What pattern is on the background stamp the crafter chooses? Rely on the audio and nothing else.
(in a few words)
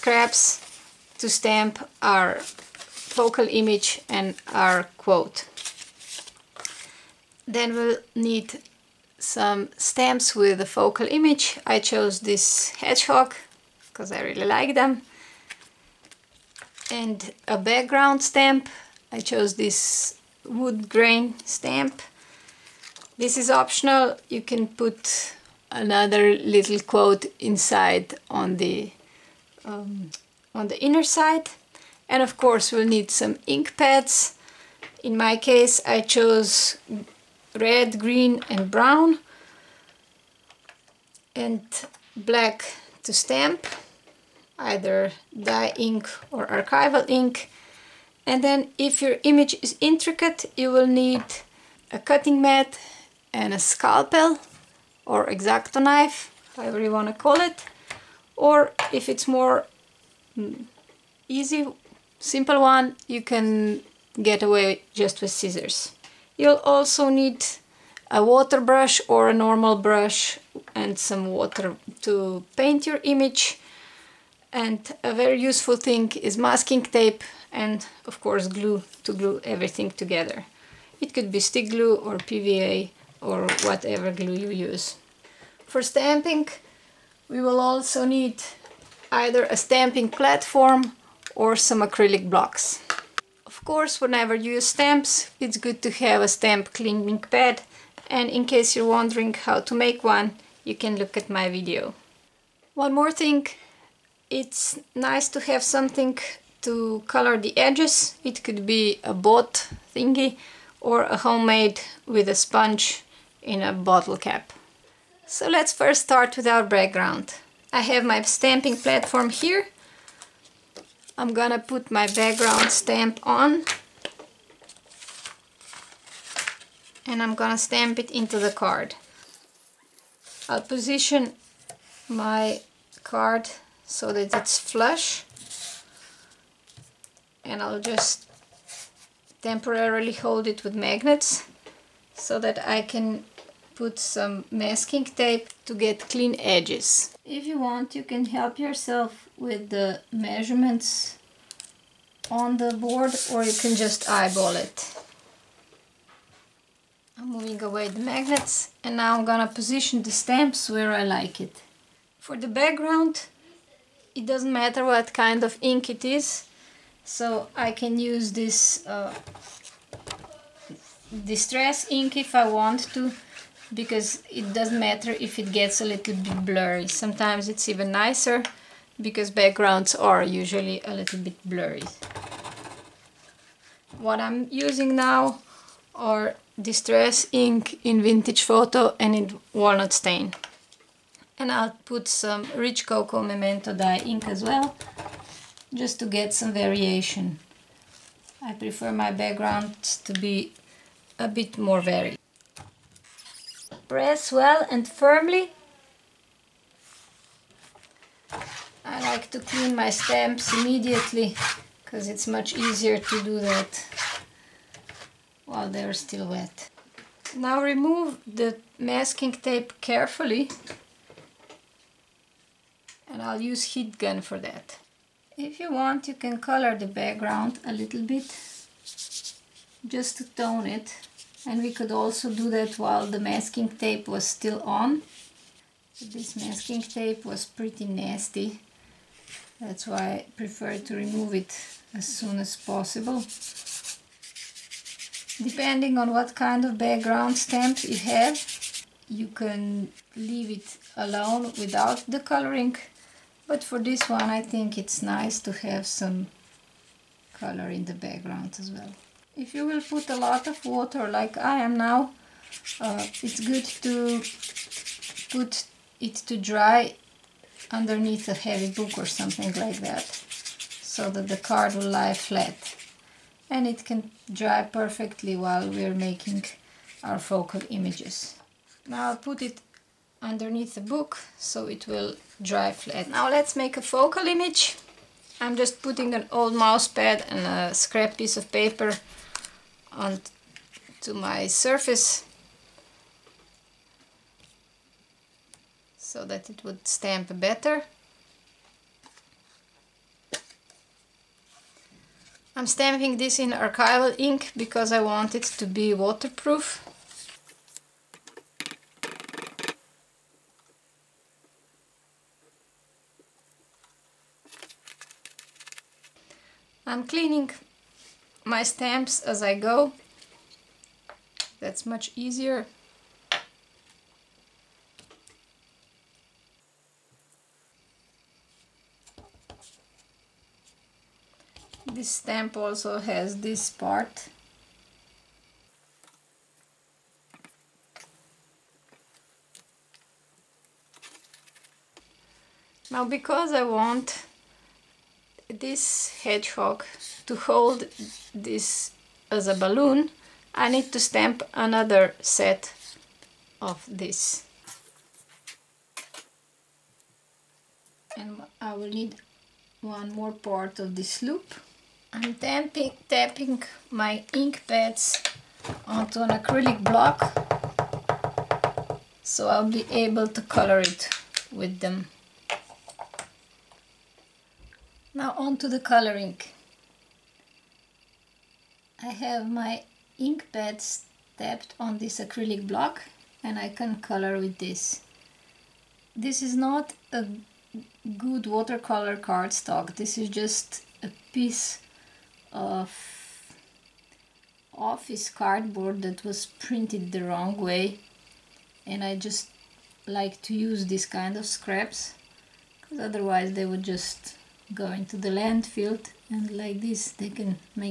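Wood grain.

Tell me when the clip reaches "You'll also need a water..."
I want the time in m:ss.
1:06.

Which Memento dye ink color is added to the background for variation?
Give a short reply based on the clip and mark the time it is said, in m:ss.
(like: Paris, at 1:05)
Rich cocoa, at 3:12.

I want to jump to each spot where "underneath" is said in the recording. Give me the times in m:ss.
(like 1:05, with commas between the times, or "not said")
4:27, 4:40.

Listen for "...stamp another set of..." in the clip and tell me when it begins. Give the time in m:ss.
5:50.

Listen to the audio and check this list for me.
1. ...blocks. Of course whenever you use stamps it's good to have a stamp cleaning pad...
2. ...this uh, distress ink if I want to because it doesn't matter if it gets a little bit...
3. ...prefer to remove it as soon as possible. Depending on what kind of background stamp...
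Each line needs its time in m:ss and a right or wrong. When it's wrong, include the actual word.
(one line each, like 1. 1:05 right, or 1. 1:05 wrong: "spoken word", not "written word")
1. 1:32 right
2. 2:48 right
3. 4:00 right.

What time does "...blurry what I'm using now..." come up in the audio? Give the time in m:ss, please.
3:01.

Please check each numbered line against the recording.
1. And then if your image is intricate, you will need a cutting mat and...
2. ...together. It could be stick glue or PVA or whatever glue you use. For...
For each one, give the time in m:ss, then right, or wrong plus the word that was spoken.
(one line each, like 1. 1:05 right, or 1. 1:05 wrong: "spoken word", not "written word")
1. 0:48 right
2. 1:19 right.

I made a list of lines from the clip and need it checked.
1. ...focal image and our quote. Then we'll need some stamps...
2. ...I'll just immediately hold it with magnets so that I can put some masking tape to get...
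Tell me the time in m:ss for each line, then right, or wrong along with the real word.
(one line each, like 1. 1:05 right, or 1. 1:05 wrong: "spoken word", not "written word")
1. 0:02 right
2. 2:17 wrong: "temporarily", not "immediately".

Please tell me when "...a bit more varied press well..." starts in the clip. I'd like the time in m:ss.
3:21.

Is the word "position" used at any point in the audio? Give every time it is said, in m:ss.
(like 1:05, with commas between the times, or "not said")
2:10, 2:39.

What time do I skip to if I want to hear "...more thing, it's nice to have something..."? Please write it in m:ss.
1:42.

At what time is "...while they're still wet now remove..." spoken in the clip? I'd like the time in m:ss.
3:35.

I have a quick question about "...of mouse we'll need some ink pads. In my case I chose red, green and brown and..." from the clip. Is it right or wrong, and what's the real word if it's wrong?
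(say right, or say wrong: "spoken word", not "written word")
wrong: "course", not "mouse".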